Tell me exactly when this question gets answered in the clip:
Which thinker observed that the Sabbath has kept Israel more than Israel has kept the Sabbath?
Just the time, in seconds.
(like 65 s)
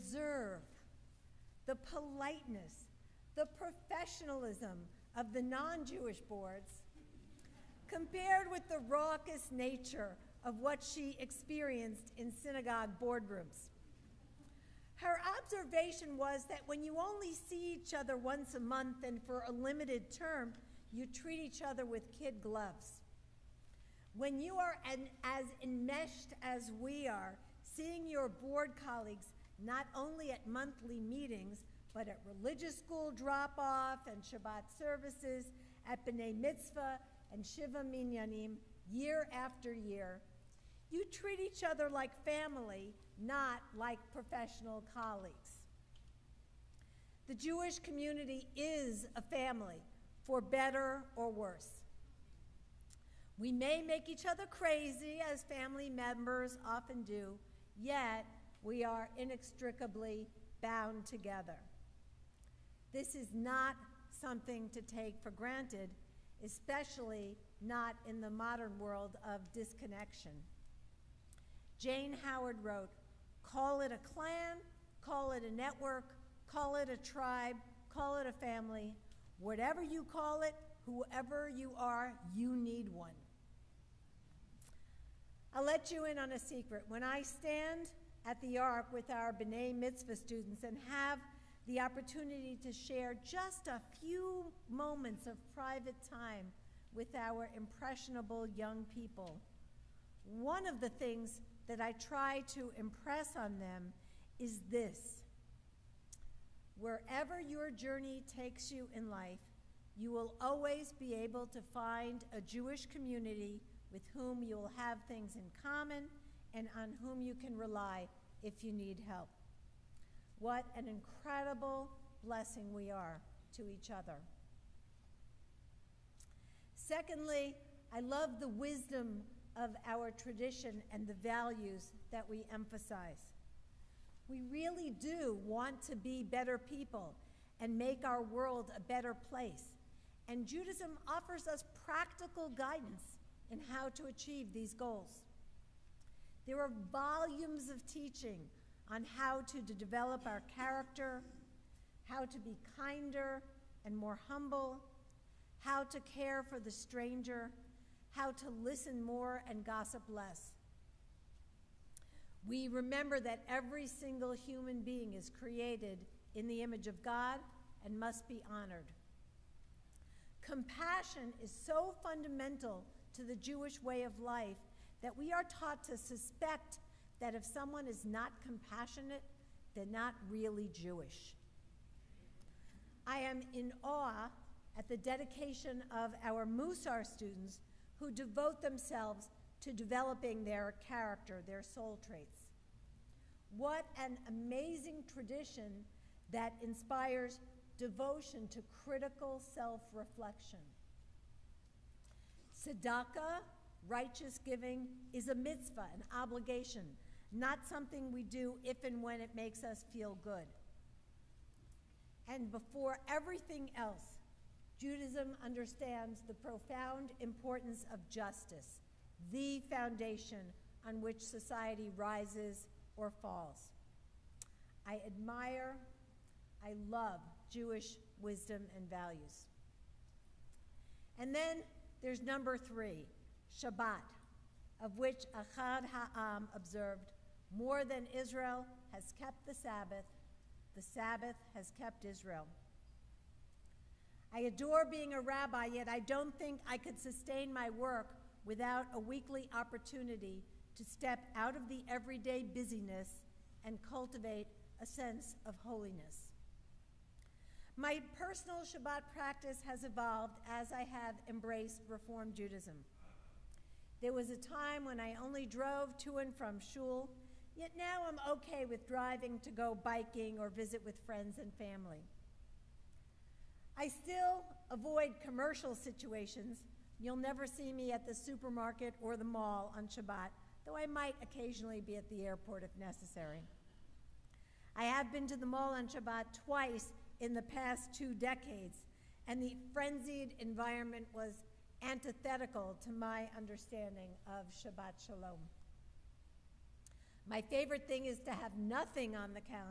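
235 s.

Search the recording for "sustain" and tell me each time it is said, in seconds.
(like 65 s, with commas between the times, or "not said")
246 s.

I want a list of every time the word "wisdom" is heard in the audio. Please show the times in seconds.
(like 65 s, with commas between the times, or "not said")
128 s, 228 s.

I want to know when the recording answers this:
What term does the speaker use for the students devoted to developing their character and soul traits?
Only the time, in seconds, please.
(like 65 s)
186 s.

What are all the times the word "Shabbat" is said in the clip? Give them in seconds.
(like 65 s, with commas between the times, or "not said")
34 s, 233 s, 258 s, 279 s, 285 s, 294 s.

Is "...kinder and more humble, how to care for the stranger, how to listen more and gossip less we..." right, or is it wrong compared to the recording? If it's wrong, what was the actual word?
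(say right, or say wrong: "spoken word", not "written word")
right.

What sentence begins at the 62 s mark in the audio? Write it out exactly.
This is not something to take for granted, especially not in the modern world of disconnection.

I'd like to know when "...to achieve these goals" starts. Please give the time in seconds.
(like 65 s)
143 s.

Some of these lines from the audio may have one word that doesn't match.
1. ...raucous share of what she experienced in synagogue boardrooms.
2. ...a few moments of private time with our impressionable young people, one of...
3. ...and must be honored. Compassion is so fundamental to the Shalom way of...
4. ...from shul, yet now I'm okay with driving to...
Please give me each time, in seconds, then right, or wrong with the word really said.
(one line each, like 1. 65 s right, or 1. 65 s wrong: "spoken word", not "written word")
1. 8 s wrong: "nature", not "share"
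2. 93 s right
3. 167 s wrong: "Jewish", not "Shalom"
4. 266 s right.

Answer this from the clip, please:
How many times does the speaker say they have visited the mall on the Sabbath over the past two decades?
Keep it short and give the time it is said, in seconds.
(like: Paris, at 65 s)
2, at 286 s.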